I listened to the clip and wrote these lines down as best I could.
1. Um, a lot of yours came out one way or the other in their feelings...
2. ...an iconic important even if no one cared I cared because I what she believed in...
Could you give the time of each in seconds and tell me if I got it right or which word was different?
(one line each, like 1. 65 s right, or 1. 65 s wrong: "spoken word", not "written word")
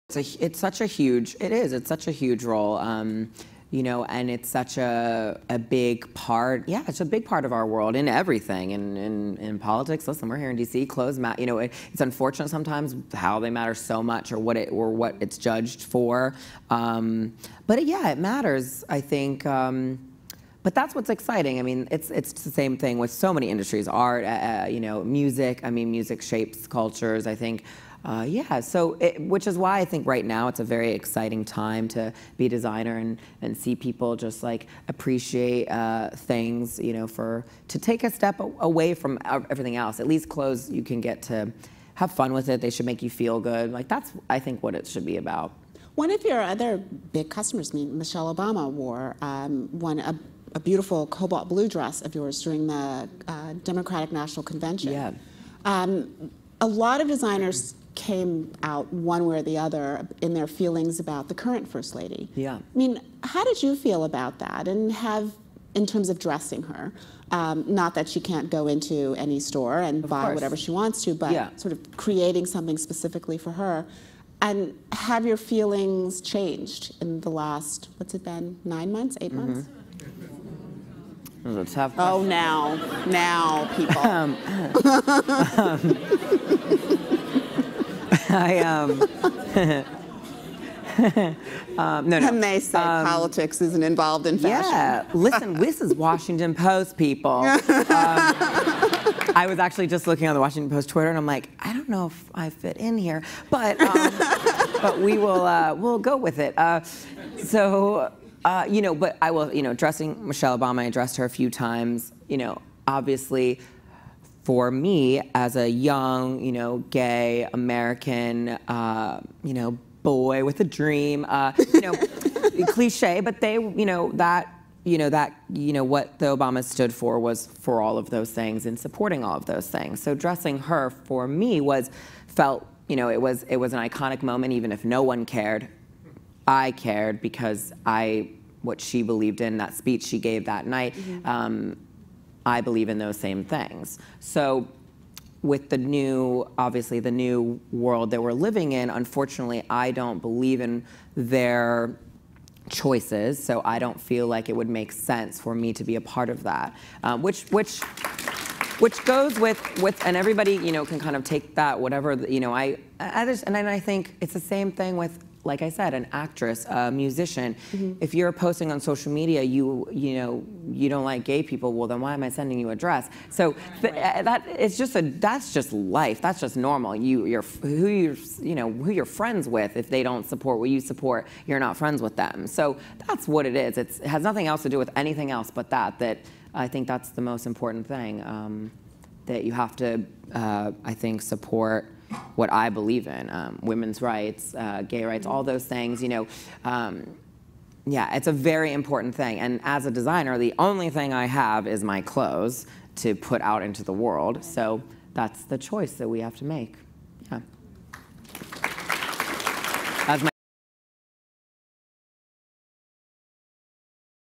1. 55 s wrong: "designers", not "yours"
2. 133 s wrong: "moment", not "important".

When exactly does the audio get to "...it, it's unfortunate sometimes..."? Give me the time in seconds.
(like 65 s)
11 s.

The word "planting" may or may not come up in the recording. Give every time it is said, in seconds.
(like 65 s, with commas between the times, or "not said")
not said.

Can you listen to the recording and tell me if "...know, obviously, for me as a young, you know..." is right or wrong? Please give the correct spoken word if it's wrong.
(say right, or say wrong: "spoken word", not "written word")
right.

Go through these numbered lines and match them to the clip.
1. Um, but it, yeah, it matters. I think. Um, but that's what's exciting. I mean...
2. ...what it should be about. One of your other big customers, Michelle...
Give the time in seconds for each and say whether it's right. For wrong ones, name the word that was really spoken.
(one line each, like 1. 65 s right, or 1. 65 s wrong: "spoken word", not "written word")
1. 16 s right
2. 44 s right.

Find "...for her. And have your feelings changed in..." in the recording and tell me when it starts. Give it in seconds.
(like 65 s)
73 s.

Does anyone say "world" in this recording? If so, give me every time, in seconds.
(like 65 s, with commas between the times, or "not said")
7 s, 147 s, 203 s.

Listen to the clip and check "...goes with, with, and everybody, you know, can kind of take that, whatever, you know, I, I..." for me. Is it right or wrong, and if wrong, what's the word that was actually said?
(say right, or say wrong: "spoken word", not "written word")
right.